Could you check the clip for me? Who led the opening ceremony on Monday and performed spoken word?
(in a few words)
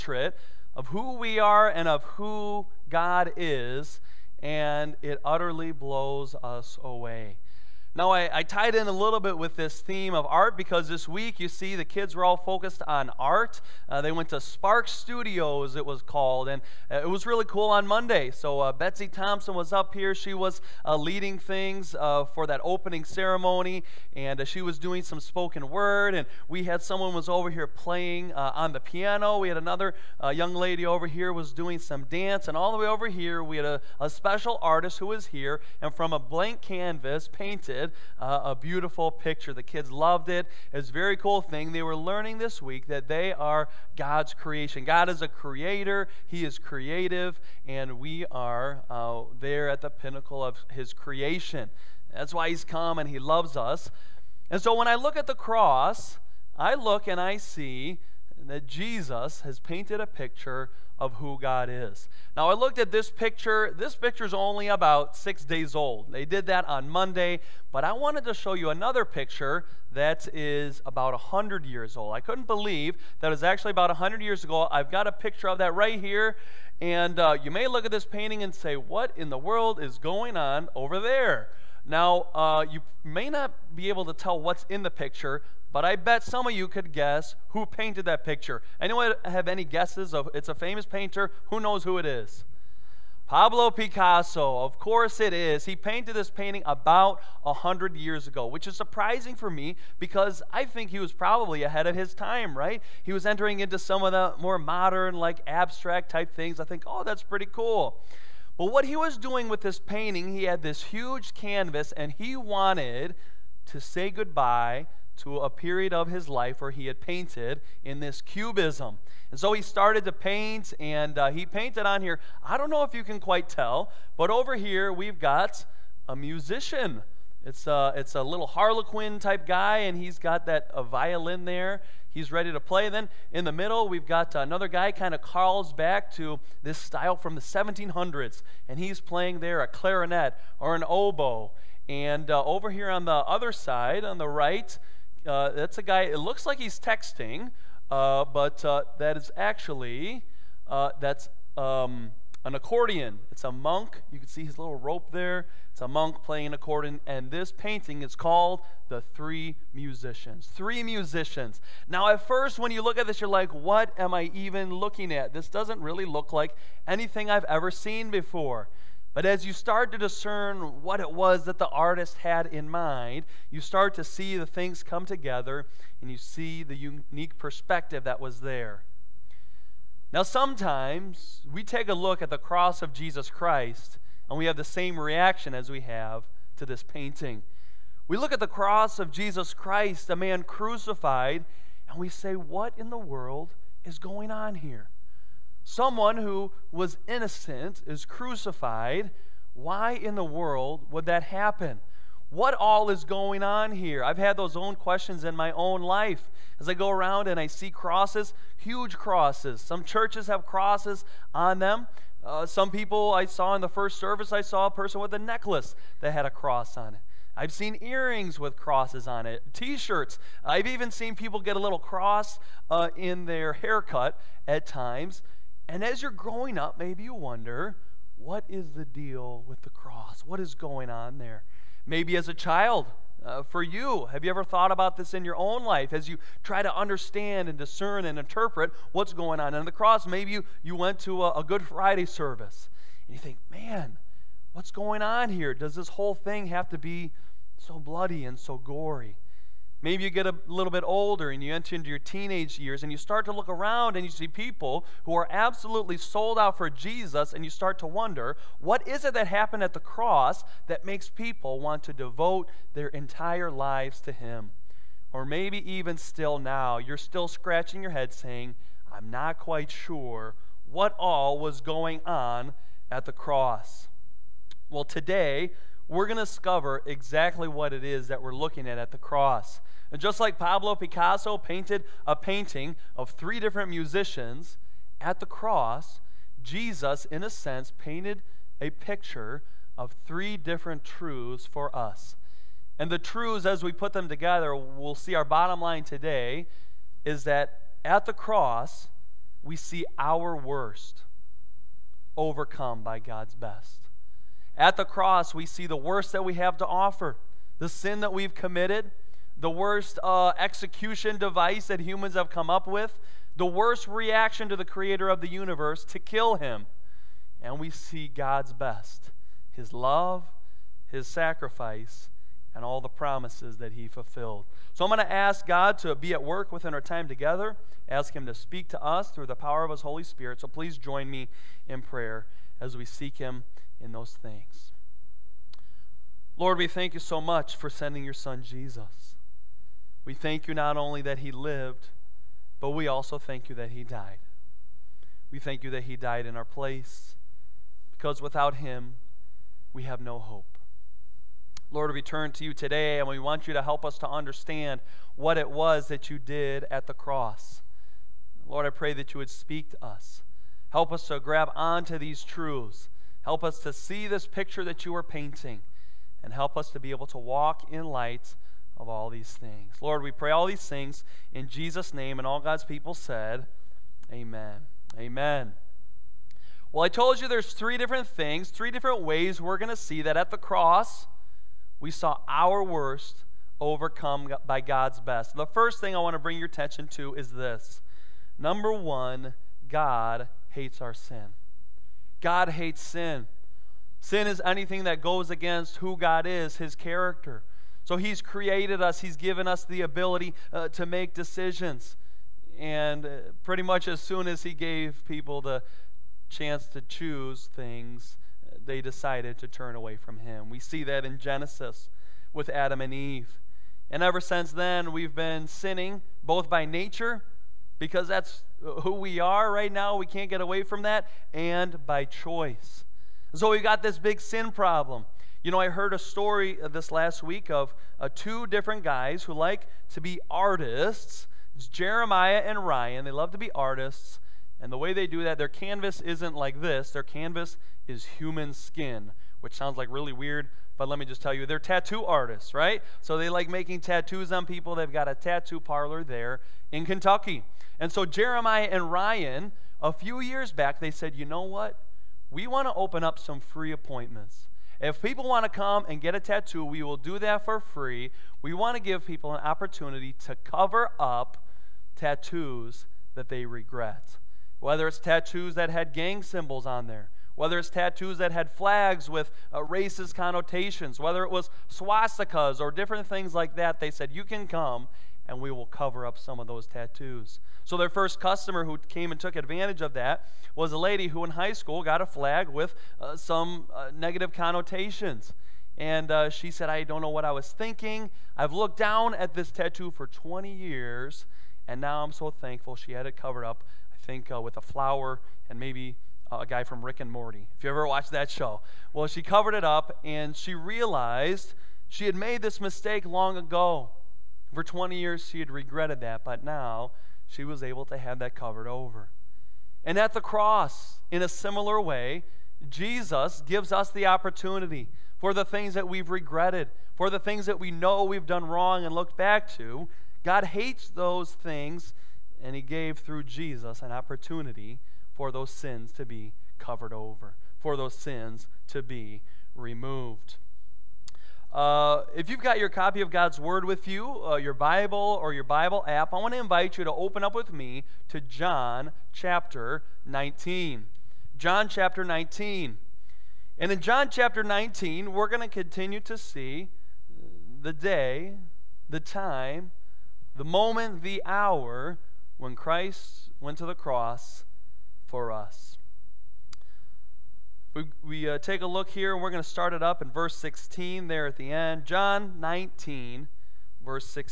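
Betsy Thompson.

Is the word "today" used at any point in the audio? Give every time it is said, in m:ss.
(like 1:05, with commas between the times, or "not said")
4:34, 4:55, 5:52.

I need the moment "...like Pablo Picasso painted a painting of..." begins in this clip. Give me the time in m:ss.
4:40.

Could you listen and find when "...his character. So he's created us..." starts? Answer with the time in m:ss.
6:36.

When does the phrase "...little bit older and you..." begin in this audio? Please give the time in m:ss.
4:10.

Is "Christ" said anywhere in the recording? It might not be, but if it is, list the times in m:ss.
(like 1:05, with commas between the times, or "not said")
3:03, 3:09, 9:12.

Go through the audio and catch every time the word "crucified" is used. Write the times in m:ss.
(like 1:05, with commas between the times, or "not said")
3:10, 3:18.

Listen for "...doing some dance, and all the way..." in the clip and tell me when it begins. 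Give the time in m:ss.
0:31.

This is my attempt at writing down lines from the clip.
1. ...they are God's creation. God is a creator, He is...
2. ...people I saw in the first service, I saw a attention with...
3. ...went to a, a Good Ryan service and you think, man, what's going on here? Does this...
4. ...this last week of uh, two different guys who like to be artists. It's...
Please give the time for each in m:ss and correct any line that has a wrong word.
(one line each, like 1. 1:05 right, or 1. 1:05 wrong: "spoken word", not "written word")
1. 0:43 right
2. 3:32 wrong: "person", not "attention"
3. 4:00 wrong: "Friday", not "Ryan"
4. 7:06 right.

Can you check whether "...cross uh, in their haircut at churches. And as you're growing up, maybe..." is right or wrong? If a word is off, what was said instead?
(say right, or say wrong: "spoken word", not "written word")
wrong: "times", not "churches".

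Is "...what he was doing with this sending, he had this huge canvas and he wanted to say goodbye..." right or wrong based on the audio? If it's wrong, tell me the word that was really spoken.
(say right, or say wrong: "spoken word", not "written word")
wrong: "painting", not "sending".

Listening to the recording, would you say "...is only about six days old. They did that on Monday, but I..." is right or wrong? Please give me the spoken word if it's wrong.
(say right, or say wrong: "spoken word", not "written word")
right.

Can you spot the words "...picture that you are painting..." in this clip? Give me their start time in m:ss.
6:04.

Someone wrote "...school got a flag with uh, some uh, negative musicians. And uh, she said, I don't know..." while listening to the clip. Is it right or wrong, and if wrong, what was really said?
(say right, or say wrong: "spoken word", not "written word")
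wrong: "connotations", not "musicians".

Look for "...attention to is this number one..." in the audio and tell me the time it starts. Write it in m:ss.
6:26.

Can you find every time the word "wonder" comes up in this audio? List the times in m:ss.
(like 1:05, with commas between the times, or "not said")
3:47, 4:17.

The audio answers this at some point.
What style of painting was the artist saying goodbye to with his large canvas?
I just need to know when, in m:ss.
1:58.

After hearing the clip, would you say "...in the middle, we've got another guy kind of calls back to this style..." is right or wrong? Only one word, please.
right.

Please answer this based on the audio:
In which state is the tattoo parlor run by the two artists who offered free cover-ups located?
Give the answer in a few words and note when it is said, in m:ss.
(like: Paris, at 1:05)
Kentucky, at 7:26.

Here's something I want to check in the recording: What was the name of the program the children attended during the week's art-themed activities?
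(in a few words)
Spark Studios.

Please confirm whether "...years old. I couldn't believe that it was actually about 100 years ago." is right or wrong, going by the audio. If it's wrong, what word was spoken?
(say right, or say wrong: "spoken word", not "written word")
right.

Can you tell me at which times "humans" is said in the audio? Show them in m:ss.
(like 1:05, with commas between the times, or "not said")
5:11, 7:18.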